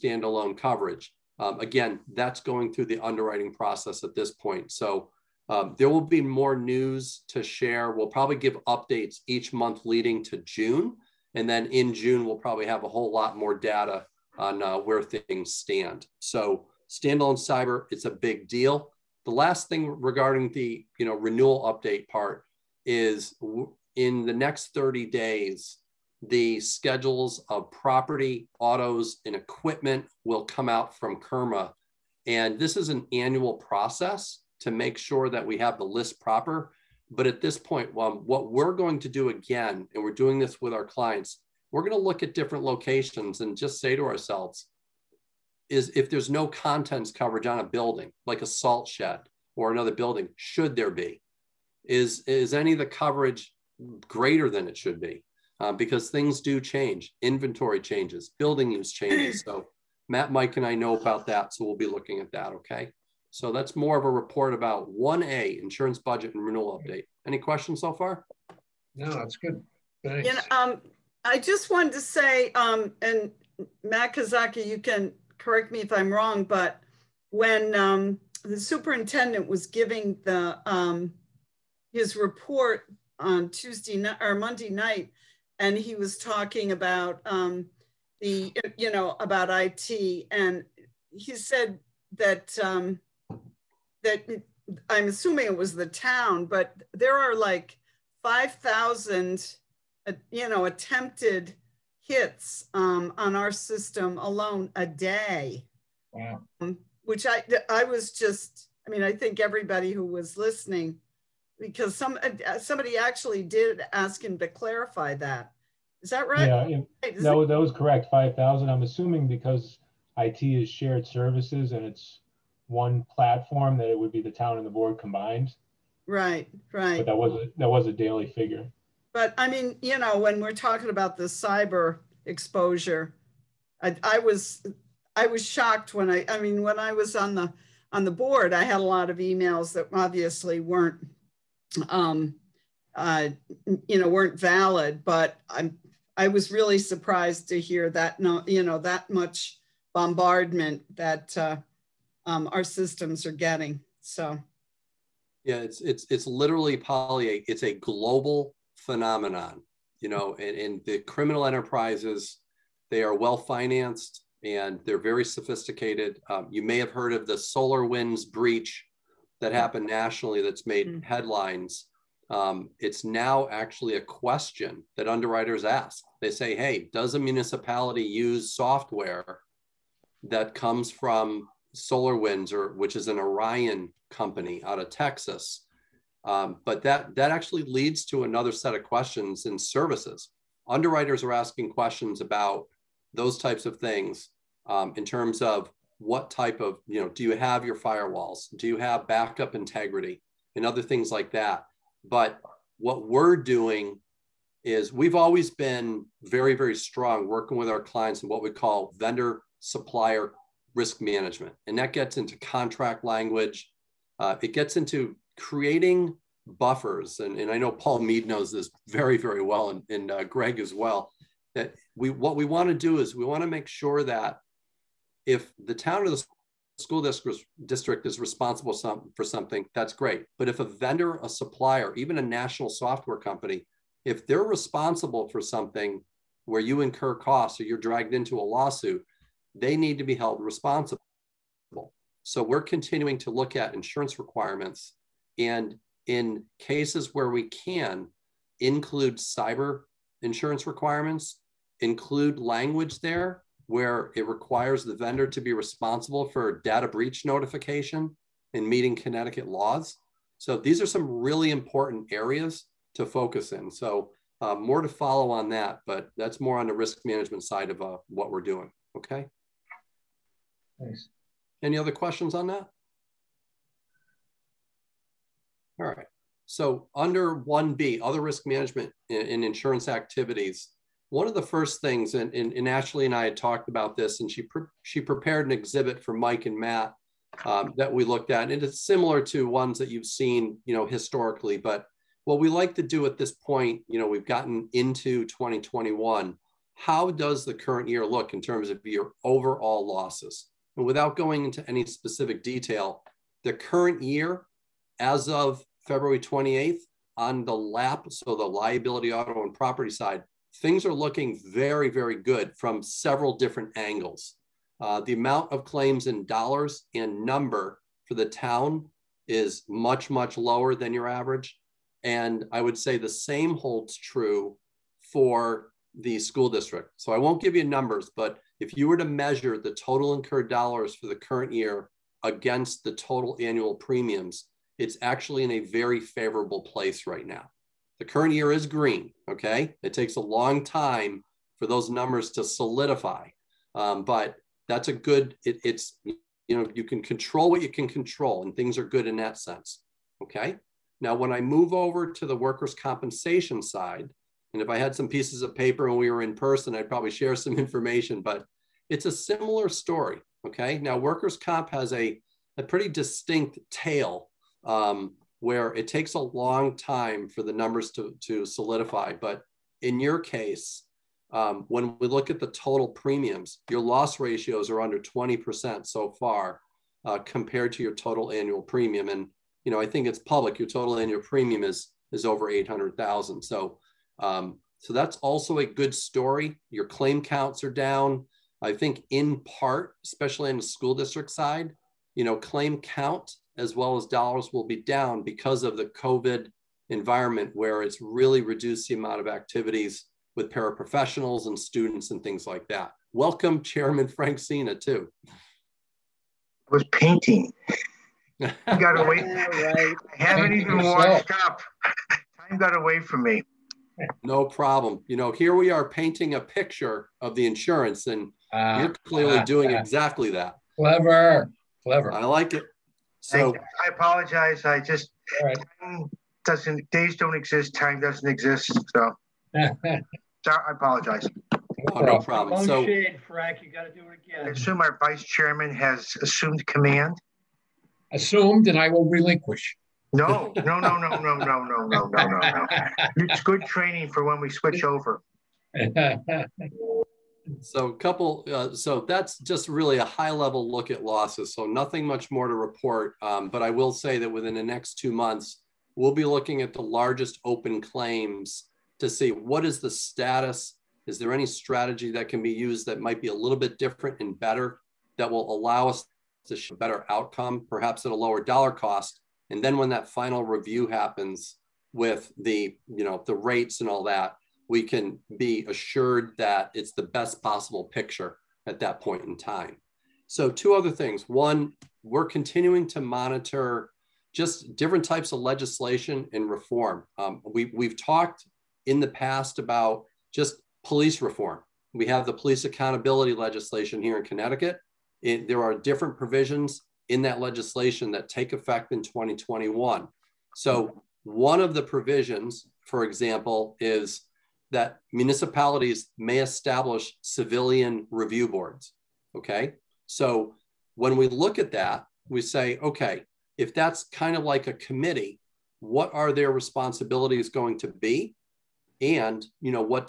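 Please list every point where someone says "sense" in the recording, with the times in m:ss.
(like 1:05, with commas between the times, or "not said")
5:49.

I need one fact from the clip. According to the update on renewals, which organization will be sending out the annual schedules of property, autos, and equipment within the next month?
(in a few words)
CIRMA.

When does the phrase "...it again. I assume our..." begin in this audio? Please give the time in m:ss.
7:14.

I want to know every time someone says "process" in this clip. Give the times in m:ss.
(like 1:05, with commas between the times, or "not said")
0:03, 0:33.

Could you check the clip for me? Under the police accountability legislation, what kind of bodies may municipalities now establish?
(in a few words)
civilian review boards.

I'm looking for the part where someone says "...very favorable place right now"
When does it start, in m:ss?
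5:35.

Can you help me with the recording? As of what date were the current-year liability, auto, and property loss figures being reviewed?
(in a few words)
February 28th.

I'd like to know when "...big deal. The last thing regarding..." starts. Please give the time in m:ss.
0:18.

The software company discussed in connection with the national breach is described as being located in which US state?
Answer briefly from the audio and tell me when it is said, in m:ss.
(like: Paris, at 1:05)
Texas, at 3:04.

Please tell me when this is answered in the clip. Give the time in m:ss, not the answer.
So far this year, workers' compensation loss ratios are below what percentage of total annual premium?
6:14.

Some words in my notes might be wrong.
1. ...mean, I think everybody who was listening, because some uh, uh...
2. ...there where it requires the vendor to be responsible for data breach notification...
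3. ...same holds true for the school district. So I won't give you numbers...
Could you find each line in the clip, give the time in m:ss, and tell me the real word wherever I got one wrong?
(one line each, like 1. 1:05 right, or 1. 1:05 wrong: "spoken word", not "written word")
1. 1:48 right
2. 4:12 right
3. 5:23 right.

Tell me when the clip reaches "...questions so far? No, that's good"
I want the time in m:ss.
1:07.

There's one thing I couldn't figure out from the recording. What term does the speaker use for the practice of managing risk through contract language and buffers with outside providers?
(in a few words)
vendor supplier risk management.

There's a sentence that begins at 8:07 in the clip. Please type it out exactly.
Um, we, we've talked in the past about just police reform.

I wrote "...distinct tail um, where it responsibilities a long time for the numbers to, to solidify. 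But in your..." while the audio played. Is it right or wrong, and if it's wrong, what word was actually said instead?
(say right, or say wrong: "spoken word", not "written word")
wrong: "takes", not "responsibilities".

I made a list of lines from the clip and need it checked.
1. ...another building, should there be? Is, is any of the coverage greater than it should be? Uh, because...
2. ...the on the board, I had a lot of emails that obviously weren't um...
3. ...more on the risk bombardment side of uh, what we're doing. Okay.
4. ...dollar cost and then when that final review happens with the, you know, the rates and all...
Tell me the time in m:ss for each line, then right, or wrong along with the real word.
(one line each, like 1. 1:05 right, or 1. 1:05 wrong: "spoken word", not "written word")
1. 0:49 right
2. 2:17 right
3. 4:26 wrong: "management", not "bombardment"
4. 7:48 right.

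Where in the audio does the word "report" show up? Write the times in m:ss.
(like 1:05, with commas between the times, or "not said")
1:04, 1:22, 7:32.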